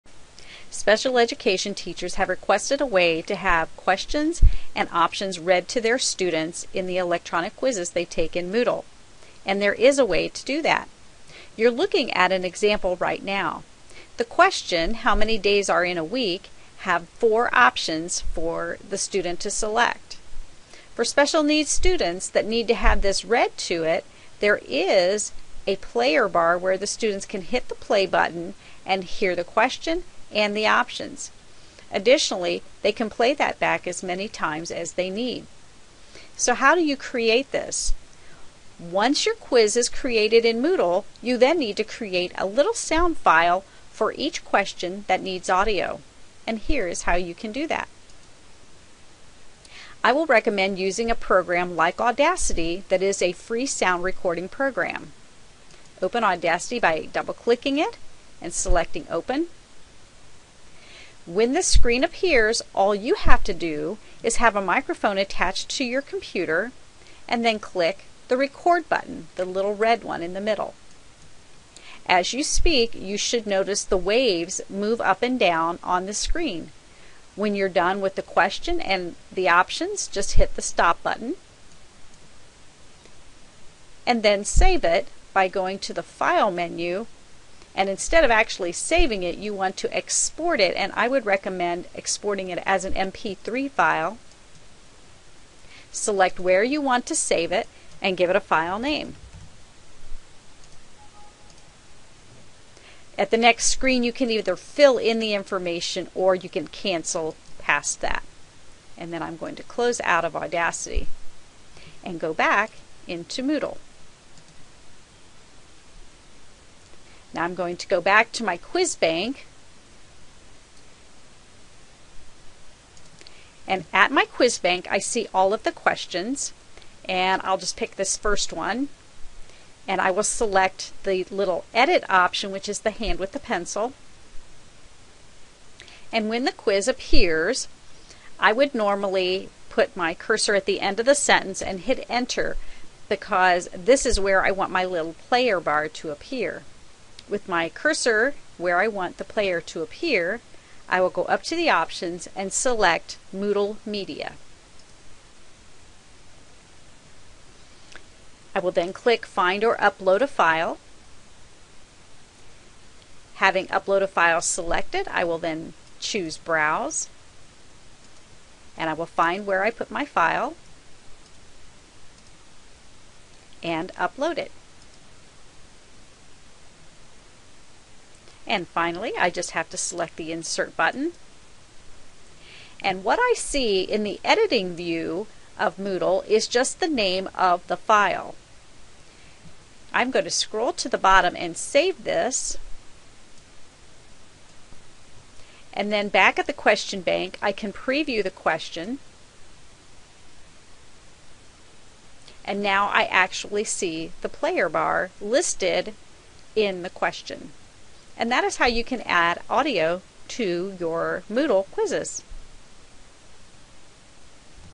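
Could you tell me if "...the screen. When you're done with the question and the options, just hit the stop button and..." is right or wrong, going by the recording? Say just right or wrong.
right.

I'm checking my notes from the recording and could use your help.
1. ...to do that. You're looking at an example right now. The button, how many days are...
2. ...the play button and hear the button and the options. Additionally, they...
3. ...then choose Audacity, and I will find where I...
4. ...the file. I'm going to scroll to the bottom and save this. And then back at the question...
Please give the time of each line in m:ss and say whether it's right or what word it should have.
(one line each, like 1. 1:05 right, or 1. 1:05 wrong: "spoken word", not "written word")
1. 0:10 wrong: "question", not "button"
2. 0:27 wrong: "question", not "button"
3. 2:45 wrong: "Browse", not "Audacity"
4. 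3:07 right.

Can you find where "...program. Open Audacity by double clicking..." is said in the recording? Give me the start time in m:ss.
0:54.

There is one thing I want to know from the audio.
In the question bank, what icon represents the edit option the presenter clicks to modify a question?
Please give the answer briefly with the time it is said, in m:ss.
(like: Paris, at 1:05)
hand with the pencil, at 2:12.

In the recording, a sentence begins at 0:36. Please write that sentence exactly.
So, how do you create this?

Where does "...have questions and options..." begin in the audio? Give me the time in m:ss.
0:03.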